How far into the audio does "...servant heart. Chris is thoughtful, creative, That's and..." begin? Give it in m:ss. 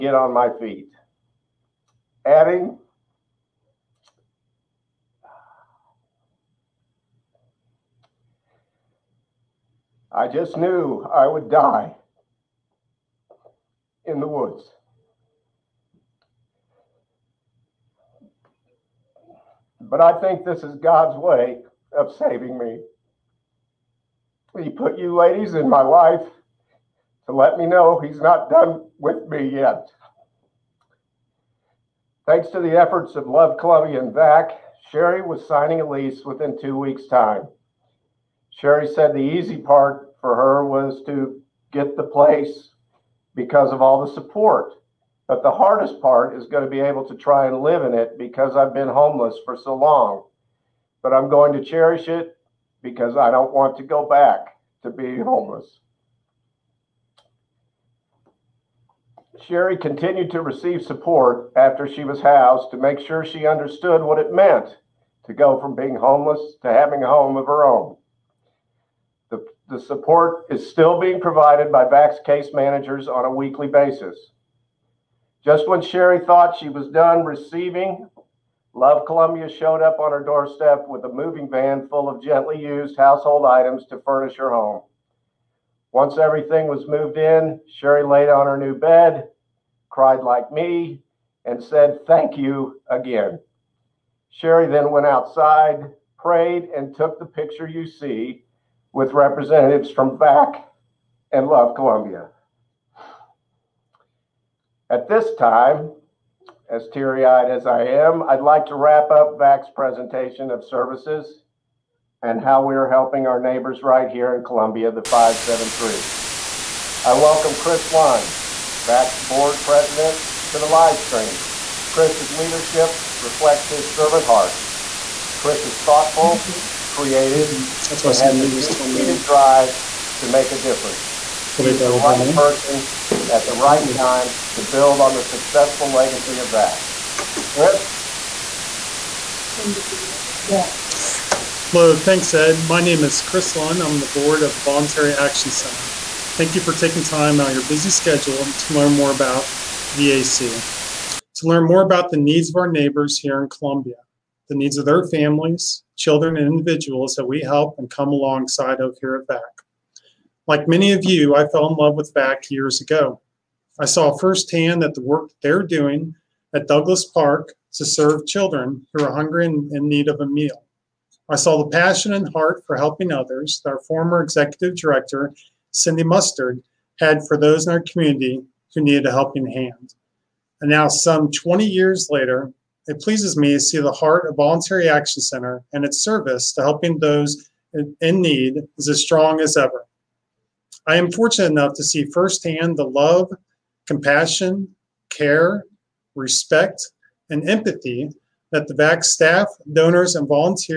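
2:03.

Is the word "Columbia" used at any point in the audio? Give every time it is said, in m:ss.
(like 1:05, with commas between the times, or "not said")
0:33, 1:19, 1:41, 1:54, 2:33.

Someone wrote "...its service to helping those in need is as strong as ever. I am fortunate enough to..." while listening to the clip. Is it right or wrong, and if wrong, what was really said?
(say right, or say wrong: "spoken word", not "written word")
right.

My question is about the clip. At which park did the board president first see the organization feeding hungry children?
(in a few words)
Douglas Park.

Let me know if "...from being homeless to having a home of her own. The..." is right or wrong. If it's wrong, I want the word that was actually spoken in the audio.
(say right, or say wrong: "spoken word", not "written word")
right.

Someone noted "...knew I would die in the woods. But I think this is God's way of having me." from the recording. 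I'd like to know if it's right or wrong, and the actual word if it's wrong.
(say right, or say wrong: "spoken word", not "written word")
wrong: "saving", not "having".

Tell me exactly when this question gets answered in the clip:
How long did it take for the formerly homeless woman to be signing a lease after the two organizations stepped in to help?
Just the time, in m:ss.
0:36.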